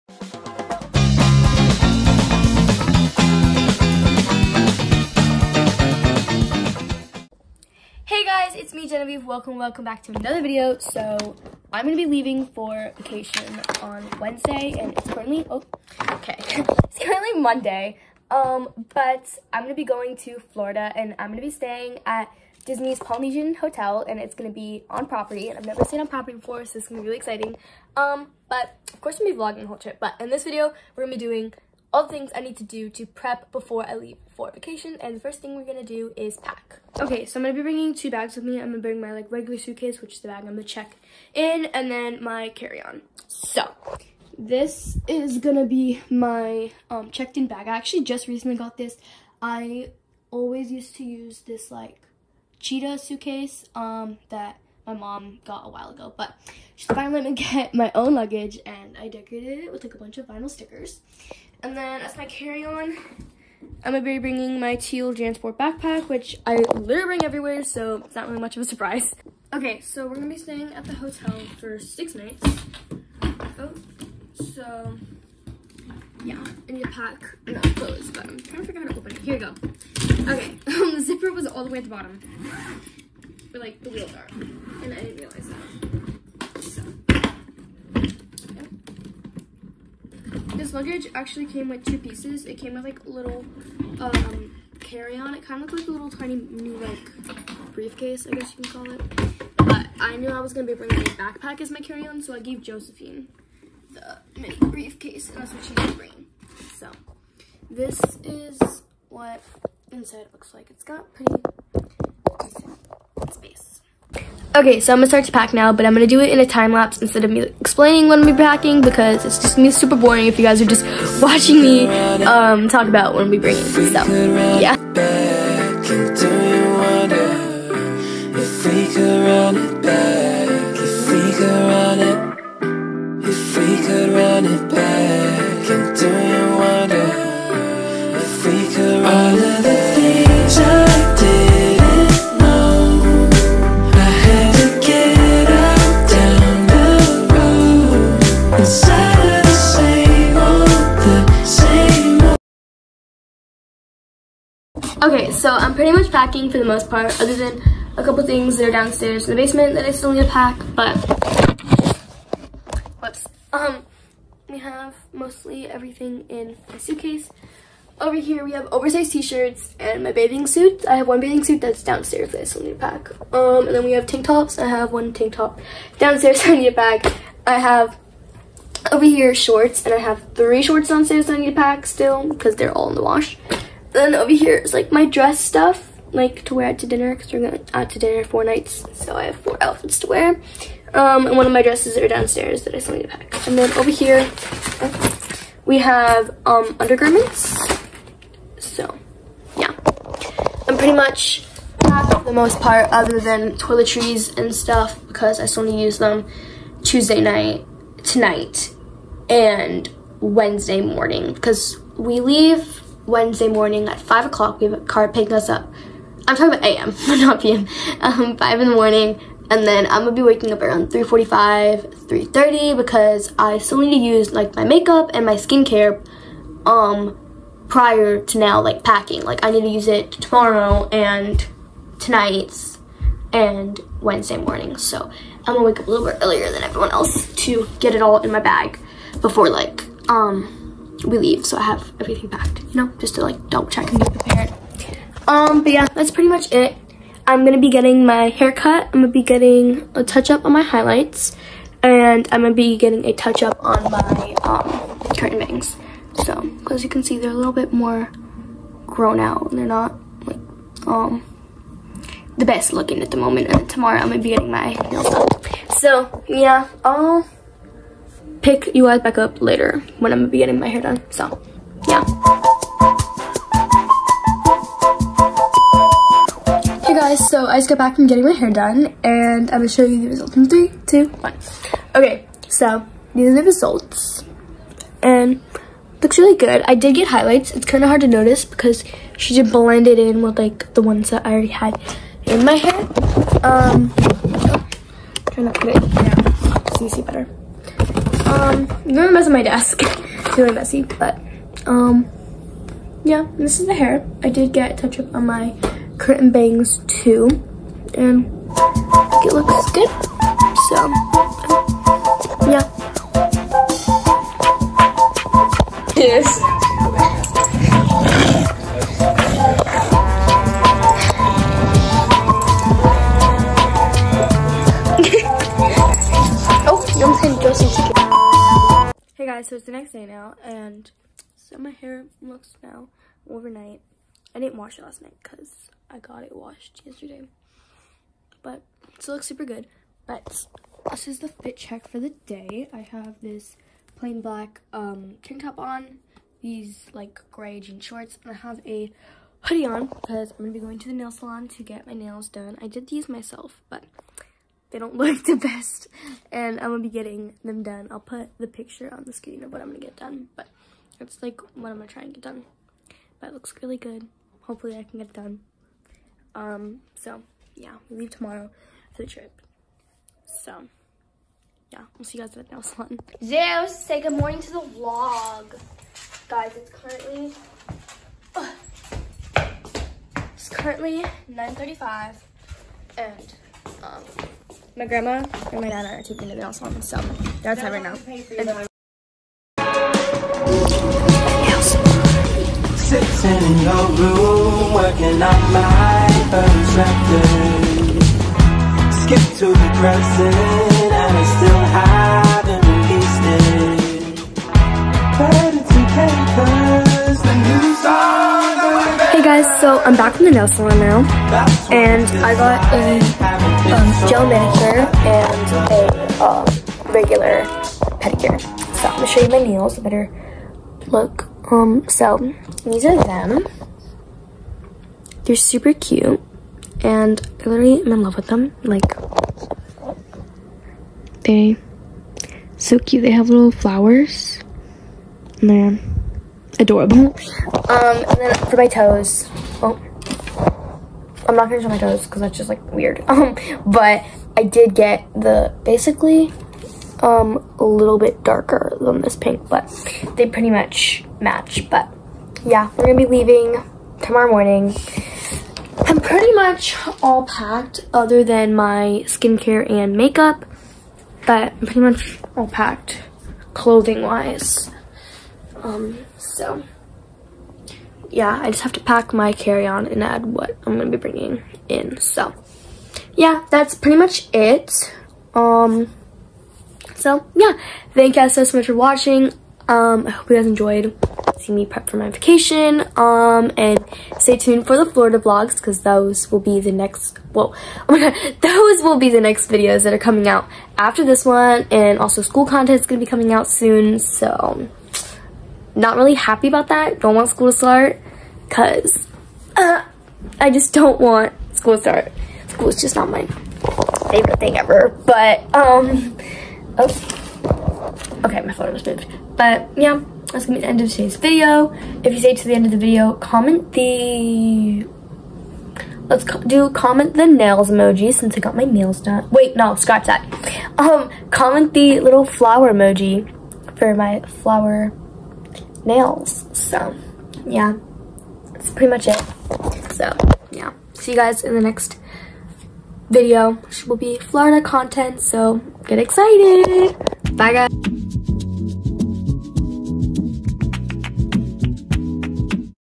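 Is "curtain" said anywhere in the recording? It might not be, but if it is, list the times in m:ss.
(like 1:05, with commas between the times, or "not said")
4:15, 5:05.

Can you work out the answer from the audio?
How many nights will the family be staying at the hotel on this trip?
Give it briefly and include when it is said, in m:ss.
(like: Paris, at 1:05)
6, at 1:11.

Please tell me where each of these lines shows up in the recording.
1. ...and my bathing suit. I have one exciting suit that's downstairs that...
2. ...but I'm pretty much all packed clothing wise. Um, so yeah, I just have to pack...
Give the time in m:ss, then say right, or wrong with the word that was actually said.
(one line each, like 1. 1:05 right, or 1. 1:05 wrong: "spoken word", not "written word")
1. 2:49 wrong: "bathing", not "exciting"
2. 7:41 right.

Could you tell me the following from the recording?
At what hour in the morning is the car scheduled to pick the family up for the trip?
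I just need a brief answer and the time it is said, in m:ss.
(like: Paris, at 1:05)
5 AM, at 3:33.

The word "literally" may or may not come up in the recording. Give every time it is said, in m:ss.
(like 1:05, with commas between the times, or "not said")
1:06, 7:07.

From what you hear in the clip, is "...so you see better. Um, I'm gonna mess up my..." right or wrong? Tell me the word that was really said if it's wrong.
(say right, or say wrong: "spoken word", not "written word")
right.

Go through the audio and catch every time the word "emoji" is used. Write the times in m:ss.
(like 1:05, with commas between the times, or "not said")
8:37, 8:42.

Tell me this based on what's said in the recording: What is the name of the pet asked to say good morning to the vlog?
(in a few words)
Zeus.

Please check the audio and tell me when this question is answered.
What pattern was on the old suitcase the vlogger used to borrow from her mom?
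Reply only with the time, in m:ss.
0:52.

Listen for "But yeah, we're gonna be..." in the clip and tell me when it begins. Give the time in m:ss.
7:31.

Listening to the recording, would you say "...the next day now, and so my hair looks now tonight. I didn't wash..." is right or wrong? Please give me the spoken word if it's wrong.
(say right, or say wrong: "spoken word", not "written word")
wrong: "overnight", not "tonight".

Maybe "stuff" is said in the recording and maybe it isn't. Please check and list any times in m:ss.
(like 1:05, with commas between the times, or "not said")
3:05, 3:24.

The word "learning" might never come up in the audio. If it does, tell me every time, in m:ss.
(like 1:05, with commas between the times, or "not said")
not said.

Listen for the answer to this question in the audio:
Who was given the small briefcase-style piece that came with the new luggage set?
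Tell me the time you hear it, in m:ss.
1:42.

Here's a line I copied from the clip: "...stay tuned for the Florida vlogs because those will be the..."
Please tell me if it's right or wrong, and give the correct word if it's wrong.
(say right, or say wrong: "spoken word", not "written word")
right.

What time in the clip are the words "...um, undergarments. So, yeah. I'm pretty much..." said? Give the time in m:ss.
3:16.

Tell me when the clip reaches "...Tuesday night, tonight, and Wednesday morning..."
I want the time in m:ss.
3:26.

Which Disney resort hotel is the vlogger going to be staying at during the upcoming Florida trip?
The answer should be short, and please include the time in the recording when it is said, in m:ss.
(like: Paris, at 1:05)
Polynesian, at 0:22.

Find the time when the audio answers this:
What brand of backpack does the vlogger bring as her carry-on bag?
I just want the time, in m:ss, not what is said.
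1:05.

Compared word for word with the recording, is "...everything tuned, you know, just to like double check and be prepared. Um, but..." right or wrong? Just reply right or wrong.
wrong.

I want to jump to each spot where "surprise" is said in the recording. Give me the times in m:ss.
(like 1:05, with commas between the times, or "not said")
1:08.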